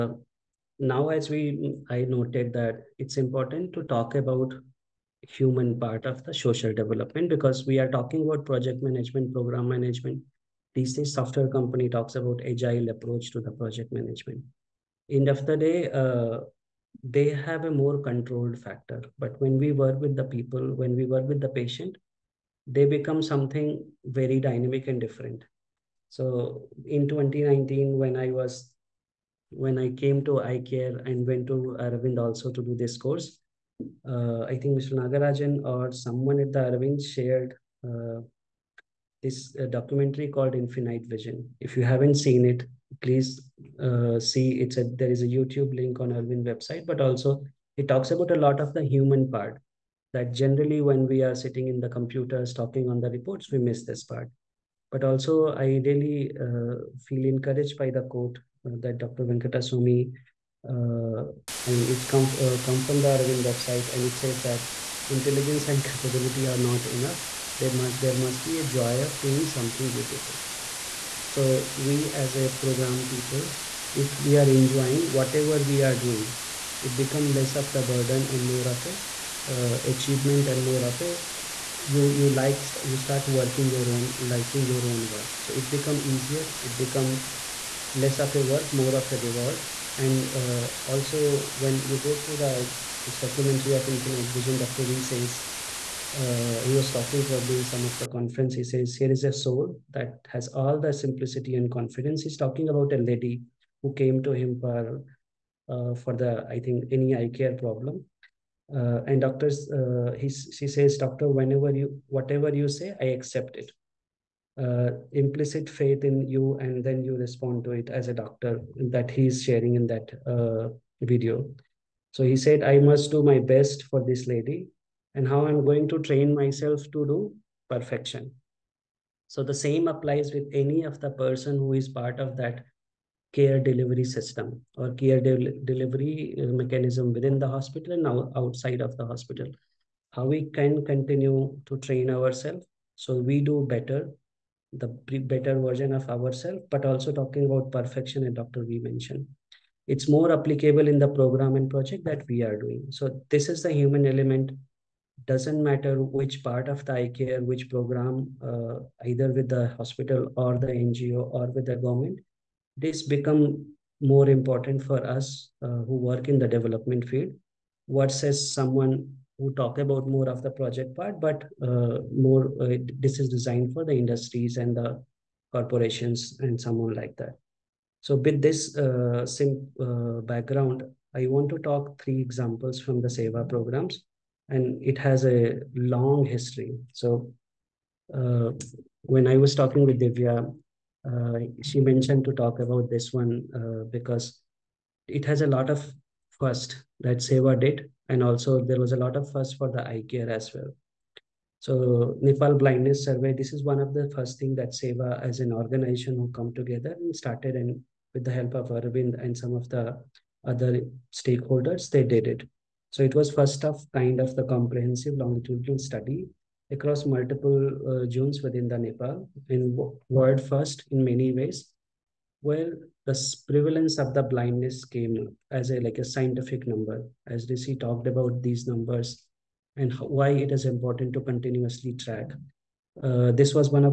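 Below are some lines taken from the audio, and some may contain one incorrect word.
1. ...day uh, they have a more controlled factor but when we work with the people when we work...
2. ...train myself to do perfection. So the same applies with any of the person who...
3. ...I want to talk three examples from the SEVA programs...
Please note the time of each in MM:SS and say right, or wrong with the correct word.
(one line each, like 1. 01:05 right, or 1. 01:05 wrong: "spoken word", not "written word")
1. 00:15 right
2. 02:05 right
3. 03:01 right.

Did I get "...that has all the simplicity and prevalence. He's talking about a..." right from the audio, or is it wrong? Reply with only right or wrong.
wrong.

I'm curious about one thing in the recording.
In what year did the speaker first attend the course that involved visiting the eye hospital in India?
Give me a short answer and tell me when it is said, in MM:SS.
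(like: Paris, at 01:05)
2019, at 00:27.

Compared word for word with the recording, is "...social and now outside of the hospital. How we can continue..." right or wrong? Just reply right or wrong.
wrong.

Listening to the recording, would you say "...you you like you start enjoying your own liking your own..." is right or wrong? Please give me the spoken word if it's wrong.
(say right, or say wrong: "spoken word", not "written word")
wrong: "working", not "enjoying".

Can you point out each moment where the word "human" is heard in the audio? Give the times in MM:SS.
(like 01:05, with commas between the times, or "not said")
00:05, 00:48, 02:33.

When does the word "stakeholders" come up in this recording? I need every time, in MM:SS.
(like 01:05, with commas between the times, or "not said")
03:31.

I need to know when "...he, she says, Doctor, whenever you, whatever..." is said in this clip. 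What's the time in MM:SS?
01:50.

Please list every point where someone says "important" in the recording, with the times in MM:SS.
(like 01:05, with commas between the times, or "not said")
00:03, 02:44, 03:50.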